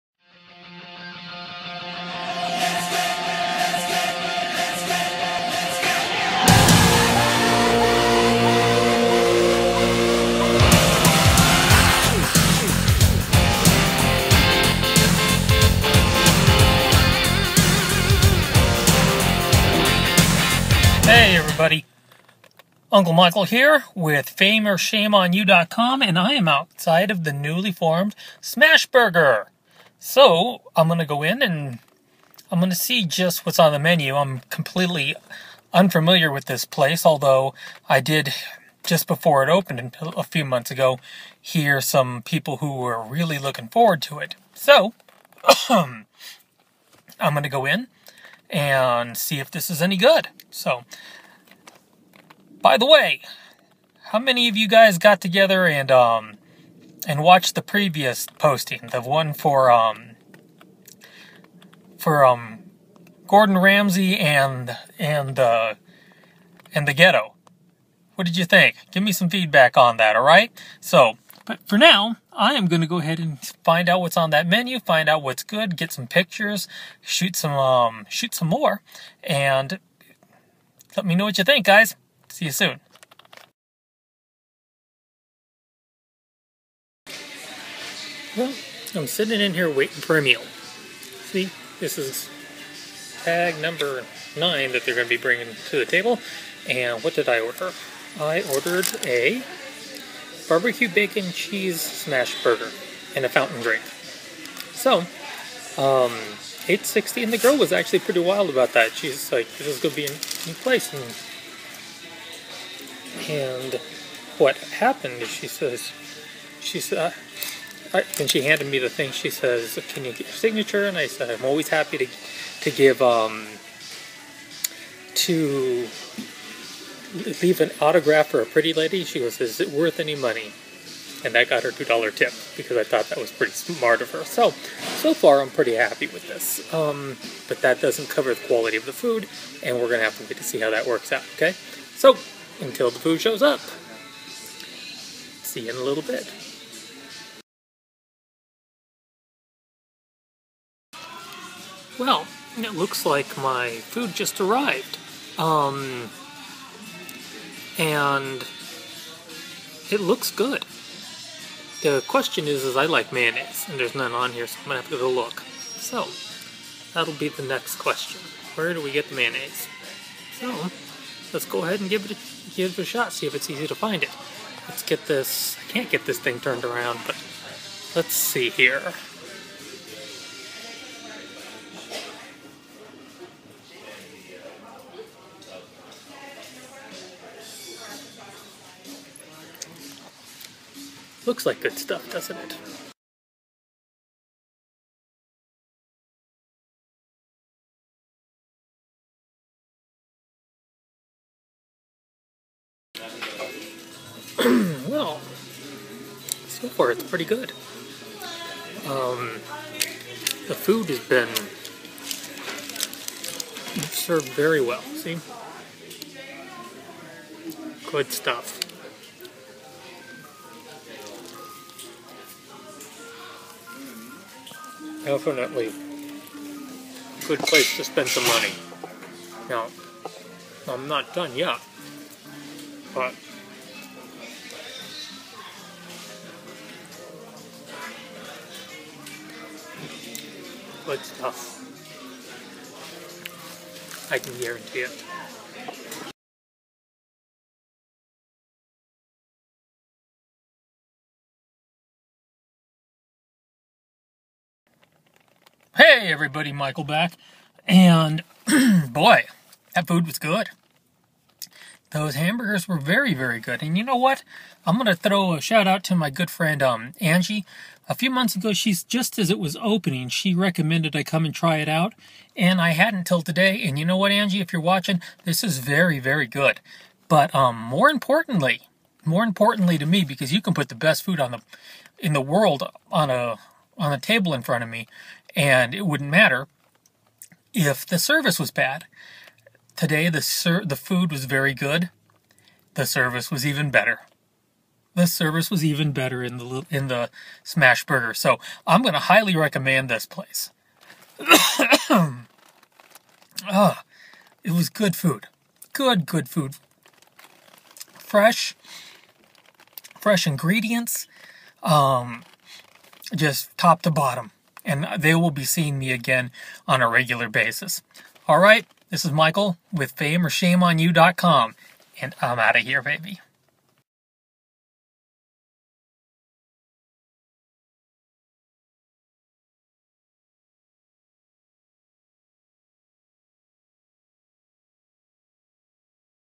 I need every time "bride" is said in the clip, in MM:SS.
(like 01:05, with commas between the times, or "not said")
not said.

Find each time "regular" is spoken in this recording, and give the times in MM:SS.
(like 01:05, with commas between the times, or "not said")
05:16.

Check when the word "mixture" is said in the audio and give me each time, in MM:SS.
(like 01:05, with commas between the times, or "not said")
not said.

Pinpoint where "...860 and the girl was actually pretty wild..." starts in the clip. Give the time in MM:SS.
01:46.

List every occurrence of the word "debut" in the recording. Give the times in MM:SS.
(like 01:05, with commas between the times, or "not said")
not said.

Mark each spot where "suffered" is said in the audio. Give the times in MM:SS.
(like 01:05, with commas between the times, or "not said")
not said.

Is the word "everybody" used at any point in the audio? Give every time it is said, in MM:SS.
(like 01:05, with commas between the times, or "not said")
00:21, 04:16.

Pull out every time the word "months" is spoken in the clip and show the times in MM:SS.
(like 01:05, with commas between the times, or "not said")
00:40, 04:28.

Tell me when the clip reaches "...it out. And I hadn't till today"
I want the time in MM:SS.
04:31.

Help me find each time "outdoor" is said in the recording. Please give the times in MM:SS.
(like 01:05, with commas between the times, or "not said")
not said.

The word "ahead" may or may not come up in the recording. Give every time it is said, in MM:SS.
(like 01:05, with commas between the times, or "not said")
01:12, 02:51.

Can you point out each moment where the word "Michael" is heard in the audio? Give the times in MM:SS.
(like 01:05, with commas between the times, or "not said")
00:23, 04:16, 05:19.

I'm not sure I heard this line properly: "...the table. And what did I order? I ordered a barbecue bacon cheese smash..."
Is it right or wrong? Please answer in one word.
right.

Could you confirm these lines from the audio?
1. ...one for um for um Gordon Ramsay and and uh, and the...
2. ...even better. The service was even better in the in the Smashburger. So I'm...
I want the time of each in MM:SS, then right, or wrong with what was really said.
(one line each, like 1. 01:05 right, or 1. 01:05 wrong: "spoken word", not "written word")
1. 00:59 right
2. 04:53 right.